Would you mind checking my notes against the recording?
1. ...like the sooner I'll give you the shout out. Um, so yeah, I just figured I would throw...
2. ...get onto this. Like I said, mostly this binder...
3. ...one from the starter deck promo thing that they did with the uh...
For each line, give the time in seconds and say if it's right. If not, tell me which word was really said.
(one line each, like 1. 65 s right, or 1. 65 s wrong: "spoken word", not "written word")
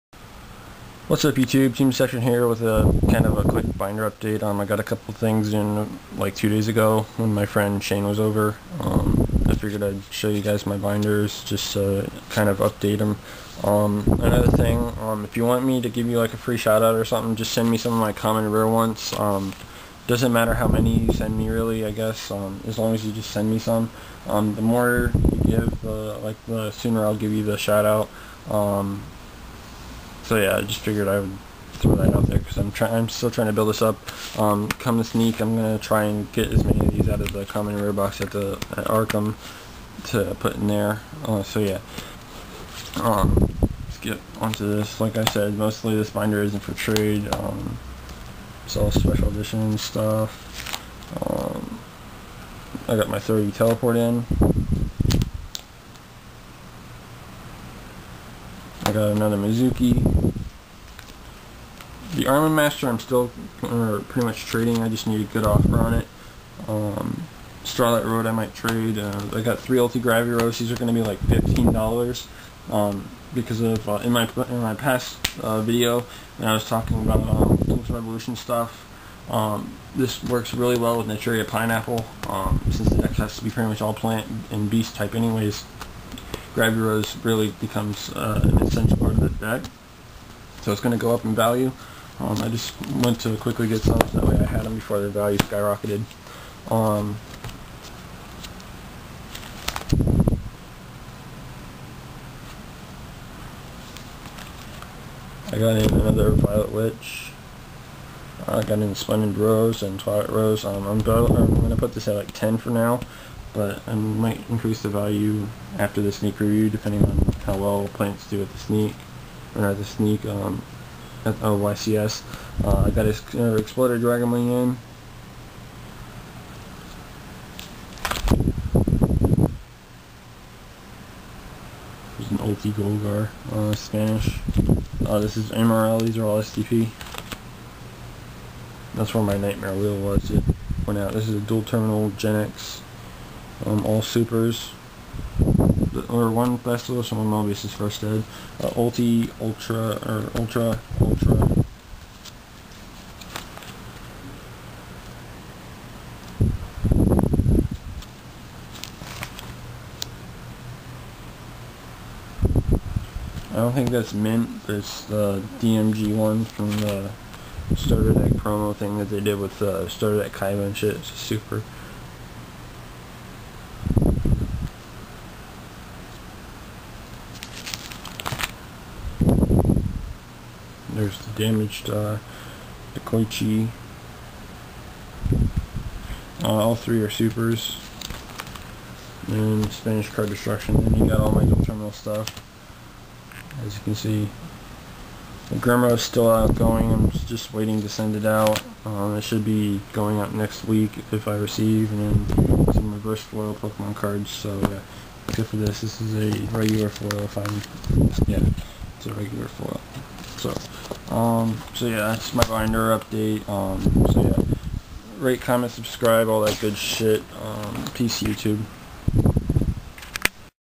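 1. 26 s right
2. 43 s right
3. 166 s right.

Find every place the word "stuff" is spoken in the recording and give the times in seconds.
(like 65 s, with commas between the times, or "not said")
49 s, 78 s, 191 s.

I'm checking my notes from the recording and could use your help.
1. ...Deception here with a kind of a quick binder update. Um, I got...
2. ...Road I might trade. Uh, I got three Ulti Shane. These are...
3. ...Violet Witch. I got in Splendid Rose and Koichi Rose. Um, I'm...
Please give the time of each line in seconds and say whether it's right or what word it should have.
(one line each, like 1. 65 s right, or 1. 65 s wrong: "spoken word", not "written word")
1. 1 s right
2. 68 s wrong: "Graviros", not "Shane"
3. 106 s wrong: "Twilight", not "Koichi".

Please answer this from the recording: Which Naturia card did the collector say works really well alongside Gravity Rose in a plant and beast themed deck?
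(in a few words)
Naturia Pineapple.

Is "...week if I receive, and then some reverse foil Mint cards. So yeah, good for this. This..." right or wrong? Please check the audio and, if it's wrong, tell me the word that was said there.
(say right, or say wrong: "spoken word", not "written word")
wrong: "Pokemon", not "Mint".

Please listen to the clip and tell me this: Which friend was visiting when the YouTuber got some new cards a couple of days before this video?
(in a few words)
Shane.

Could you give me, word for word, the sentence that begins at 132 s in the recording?
There's an Ulti Golgar, uh, Spanish.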